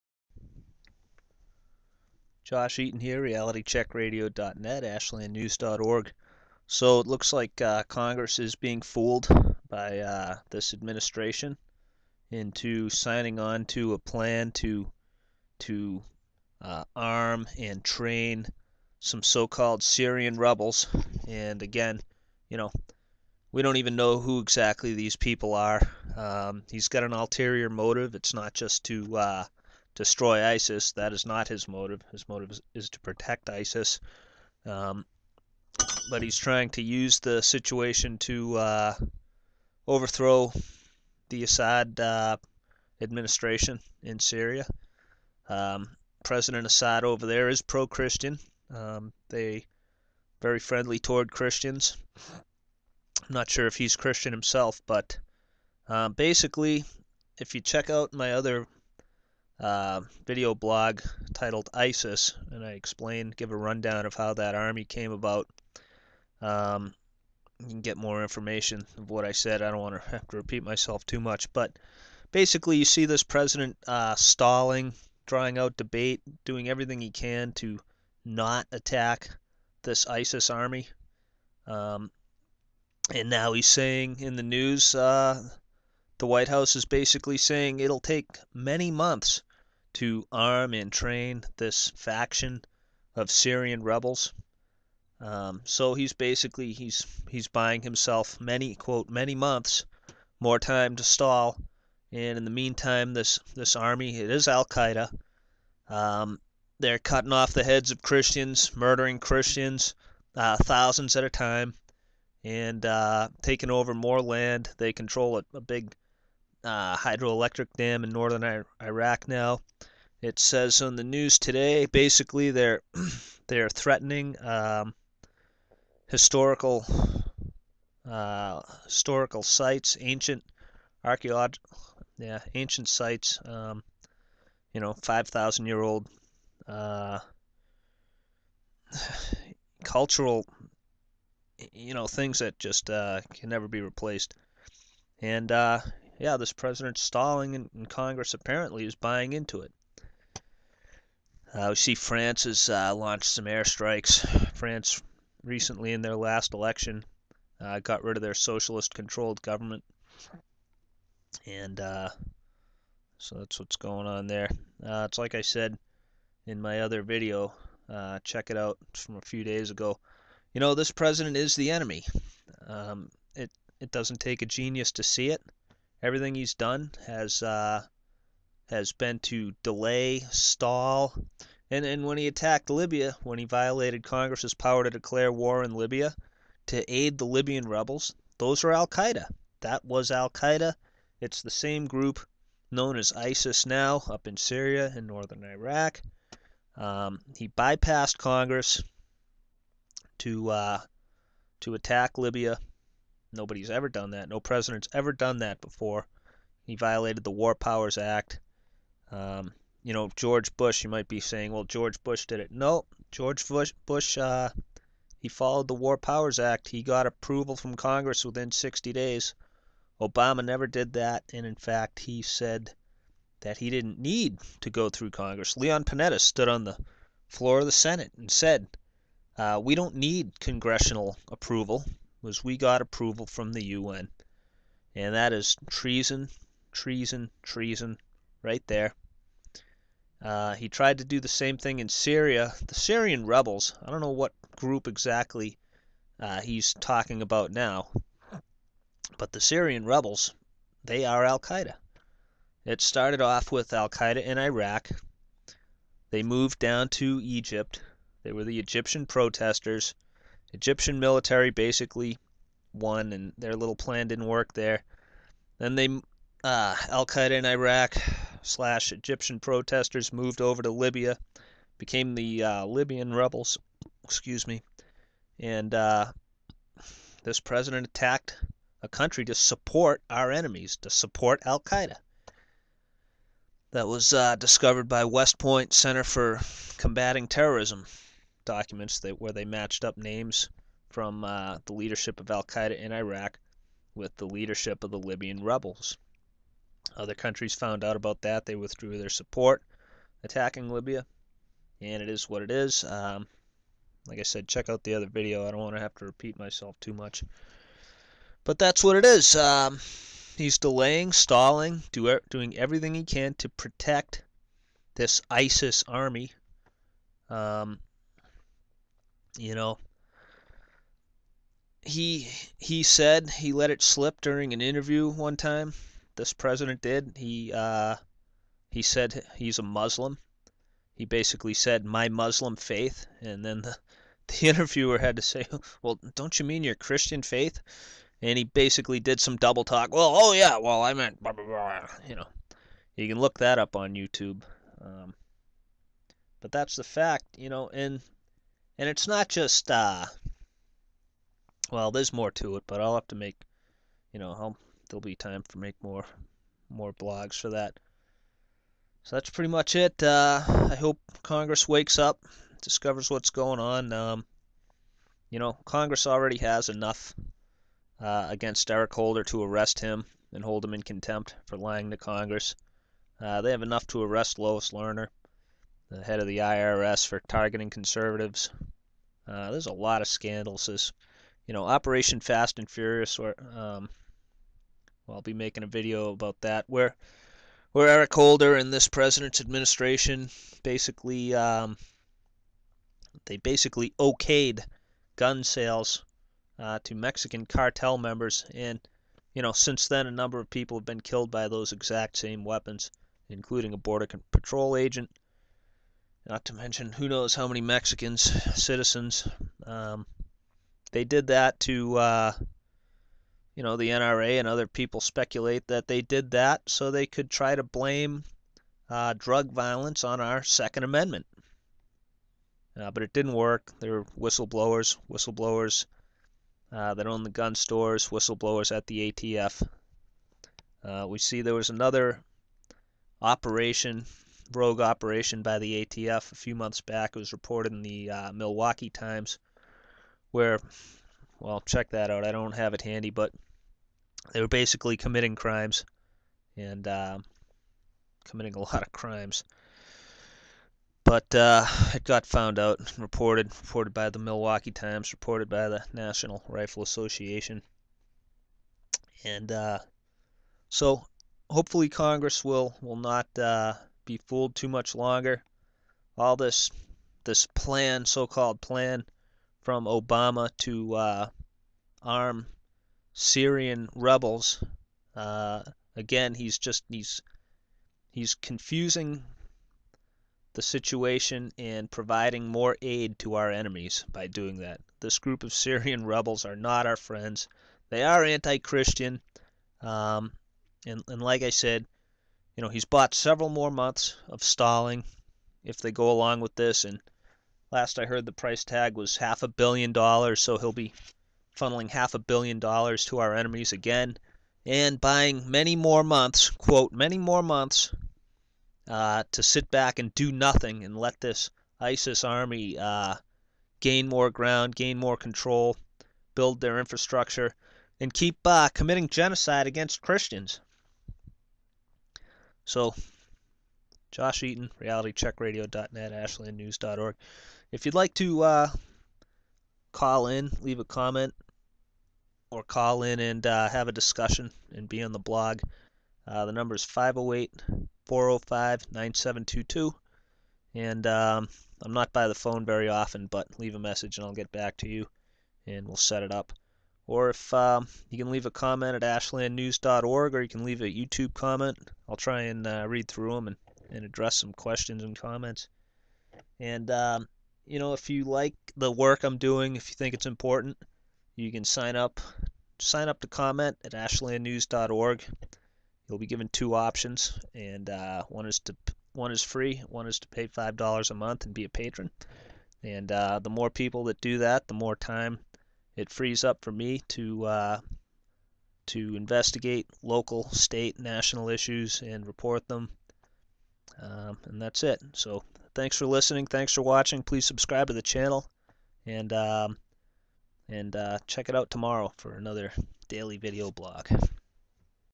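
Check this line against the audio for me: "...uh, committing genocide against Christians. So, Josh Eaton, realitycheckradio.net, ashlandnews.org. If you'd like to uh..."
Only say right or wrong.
right.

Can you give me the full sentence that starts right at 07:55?
Uh, again, he's just he's he's confusing the situation and providing more aid to our enemies by doing that.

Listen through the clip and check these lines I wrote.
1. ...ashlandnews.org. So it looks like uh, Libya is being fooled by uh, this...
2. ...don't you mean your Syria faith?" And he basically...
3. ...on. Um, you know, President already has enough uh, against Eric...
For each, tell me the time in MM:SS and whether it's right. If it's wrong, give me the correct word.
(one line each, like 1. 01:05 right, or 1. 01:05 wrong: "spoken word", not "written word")
1. 00:04 wrong: "Congress", not "Libya"
2. 05:36 wrong: "Christian", not "Syria"
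3. 06:03 wrong: "Congress", not "President".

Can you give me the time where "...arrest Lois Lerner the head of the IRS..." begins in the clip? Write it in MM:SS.
06:14.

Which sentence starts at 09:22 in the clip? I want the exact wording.
Sign up to comment at ashlandnews.org.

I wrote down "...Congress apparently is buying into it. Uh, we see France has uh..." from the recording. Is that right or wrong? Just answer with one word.
right.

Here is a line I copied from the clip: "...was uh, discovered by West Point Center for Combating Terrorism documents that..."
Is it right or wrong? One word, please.
right.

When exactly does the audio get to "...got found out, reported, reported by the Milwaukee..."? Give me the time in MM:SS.
07:32.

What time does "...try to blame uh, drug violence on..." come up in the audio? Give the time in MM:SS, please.
06:57.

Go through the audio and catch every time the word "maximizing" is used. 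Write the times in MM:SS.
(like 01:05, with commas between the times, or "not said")
not said.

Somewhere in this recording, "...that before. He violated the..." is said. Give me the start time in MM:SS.
03:25.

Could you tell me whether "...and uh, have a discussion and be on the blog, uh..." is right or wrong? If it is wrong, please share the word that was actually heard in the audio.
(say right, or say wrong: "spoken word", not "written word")
right.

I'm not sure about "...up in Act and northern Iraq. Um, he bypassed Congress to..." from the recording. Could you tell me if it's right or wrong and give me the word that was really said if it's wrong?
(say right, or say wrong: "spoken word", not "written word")
wrong: "Syria", not "Act".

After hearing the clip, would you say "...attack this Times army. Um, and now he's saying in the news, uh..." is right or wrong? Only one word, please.
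wrong.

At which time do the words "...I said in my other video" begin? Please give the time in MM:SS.
02:45.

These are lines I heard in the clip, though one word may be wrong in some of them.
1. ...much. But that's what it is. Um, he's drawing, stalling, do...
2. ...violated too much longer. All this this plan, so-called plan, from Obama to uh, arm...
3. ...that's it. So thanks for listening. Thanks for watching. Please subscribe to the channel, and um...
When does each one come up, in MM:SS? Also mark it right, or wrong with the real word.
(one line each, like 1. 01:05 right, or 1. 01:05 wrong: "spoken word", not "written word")
1. 05:06 wrong: "delaying", not "drawing"
2. 07:44 wrong: "fooled", not "violated"
3. 09:44 right.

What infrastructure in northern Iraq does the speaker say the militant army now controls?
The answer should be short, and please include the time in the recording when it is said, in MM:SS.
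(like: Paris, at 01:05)
hydroelectric dam, at 01:56.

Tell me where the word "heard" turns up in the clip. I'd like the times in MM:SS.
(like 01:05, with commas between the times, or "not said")
08:18.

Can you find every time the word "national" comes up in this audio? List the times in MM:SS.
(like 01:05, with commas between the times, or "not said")
07:35, 09:40.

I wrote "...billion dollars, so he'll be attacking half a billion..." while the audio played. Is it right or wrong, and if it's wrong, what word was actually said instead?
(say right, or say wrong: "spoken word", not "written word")
wrong: "funneling", not "attacking".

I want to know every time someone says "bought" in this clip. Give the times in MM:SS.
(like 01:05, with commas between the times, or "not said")
08:12.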